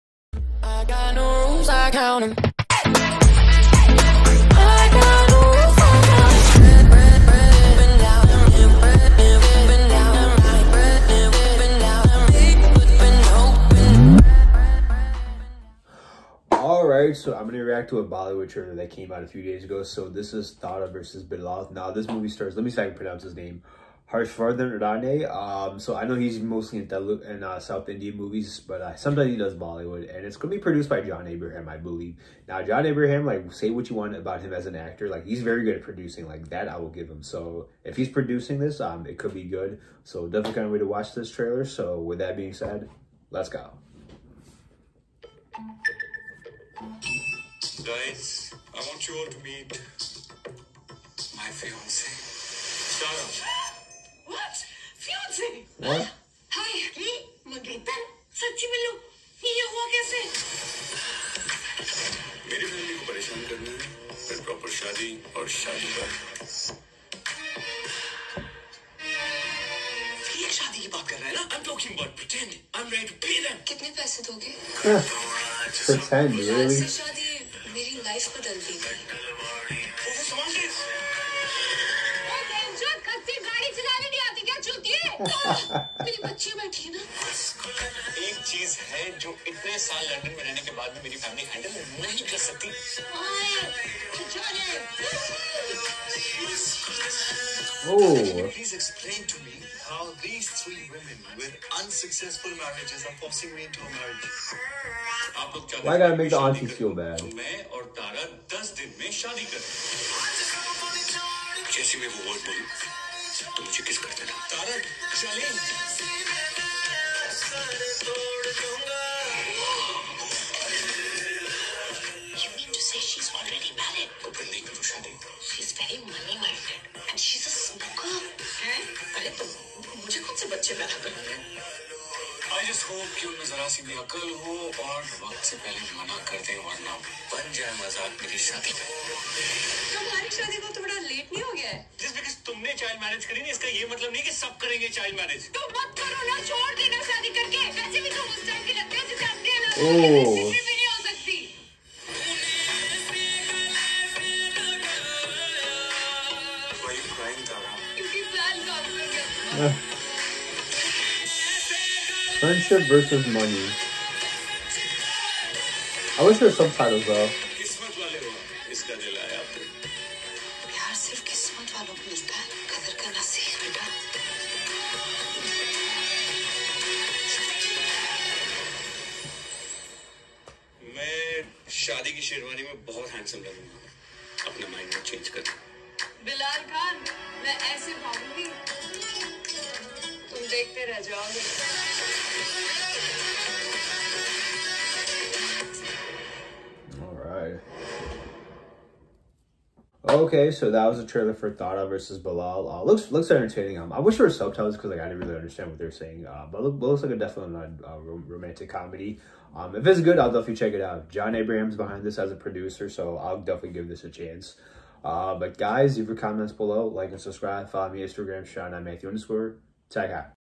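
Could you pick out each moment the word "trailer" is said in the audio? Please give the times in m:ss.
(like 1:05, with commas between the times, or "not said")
0:18, 0:41, 3:21.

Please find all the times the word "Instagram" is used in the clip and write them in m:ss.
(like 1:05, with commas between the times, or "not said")
3:38.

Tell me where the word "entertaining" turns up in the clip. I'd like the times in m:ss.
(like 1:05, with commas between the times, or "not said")
3:23.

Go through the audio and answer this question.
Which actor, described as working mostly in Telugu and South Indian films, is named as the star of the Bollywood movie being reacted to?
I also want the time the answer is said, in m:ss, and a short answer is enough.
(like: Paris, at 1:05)
Harshvardhan Rane, at 0:24.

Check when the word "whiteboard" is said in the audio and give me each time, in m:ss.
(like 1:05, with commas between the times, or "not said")
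not said.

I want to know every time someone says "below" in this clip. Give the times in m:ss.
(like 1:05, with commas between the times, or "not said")
3:36.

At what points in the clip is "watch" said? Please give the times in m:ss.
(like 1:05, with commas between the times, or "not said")
0:40.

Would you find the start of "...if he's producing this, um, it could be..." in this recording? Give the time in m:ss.
0:37.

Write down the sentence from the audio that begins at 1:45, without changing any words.
Why gotta make the aunties feel bad?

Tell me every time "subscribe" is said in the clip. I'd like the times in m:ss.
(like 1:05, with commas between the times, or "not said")
3:37.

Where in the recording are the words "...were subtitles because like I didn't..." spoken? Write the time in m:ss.
3:24.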